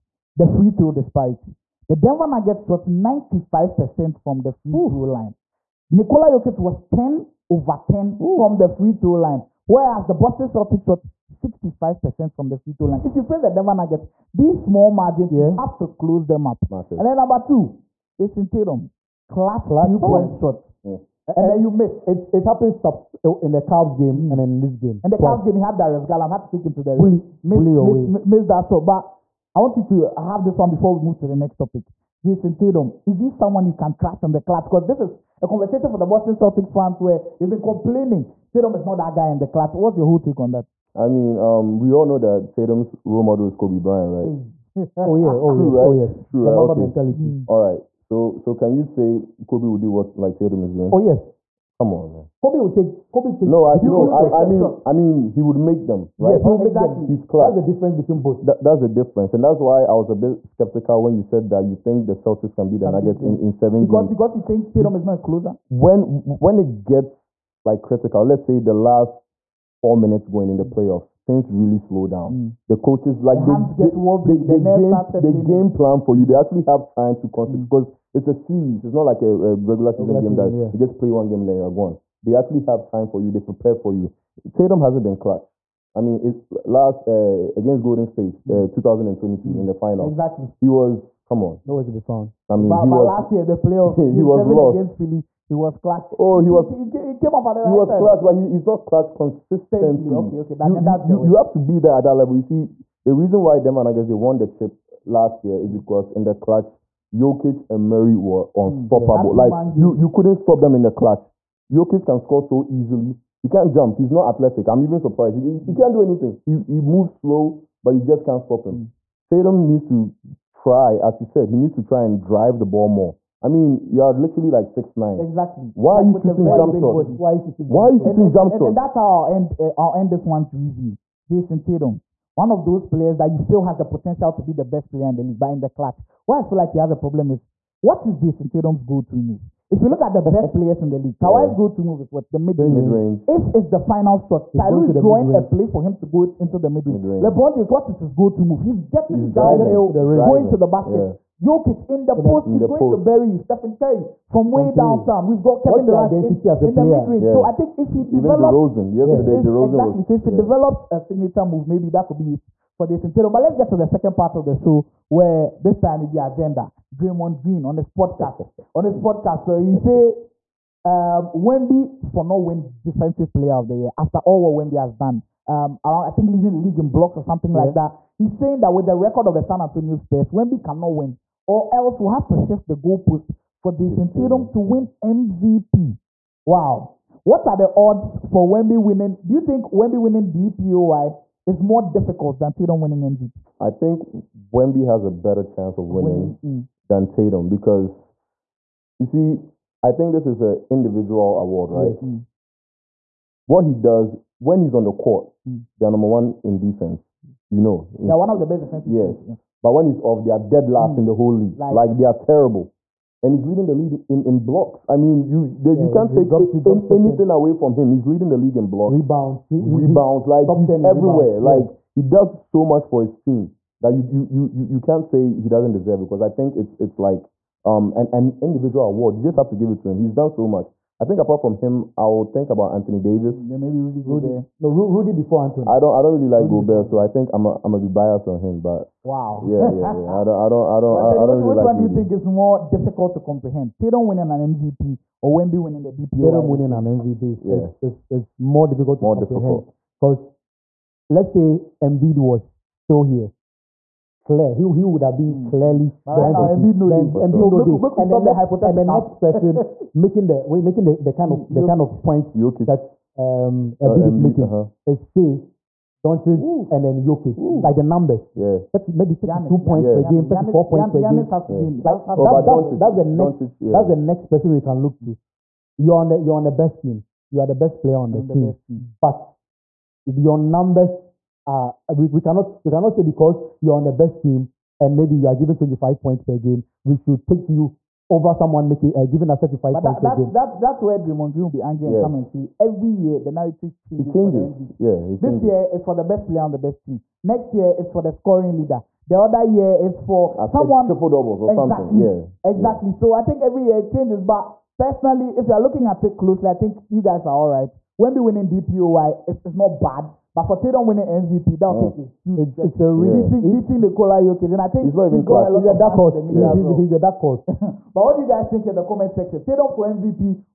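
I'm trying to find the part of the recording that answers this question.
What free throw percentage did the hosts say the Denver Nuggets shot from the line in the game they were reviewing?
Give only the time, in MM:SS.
00:02.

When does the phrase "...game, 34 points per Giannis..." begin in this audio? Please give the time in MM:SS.
04:30.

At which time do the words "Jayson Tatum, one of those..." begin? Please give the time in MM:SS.
02:11.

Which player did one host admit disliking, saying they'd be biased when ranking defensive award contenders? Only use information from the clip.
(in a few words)
Rudy Gobert.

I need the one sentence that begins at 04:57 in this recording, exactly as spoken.
Next year is for the scoring leader.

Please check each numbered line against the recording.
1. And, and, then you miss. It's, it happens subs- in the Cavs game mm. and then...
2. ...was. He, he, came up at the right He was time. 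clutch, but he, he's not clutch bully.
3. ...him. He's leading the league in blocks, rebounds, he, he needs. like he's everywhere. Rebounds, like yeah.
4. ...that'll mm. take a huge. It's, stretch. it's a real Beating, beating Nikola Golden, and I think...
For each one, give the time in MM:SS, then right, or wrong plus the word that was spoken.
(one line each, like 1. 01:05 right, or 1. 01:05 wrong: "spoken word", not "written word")
1. 00:21 right
2. 01:36 wrong: "consistently", not "bully"
3. 03:37 wrong: "rebounds", not "needs"
4. 05:11 wrong: "Jokic", not "Golden".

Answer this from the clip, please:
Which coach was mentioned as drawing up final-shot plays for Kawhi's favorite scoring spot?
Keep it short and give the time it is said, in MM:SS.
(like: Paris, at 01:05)
Ty Lue, at 02:24.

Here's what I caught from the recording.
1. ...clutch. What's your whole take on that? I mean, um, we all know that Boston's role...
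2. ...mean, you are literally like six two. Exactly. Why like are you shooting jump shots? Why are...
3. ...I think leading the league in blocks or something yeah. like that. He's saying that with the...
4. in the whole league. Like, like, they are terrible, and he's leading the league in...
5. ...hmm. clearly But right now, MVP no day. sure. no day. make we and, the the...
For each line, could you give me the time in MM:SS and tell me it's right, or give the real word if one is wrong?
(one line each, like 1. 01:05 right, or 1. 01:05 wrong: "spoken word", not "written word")
1. 00:39 wrong: "Tatum", not "Boston"
2. 02:03 wrong: "nine", not "two"
3. 02:56 right
4. 03:30 right
5. 04:15 right.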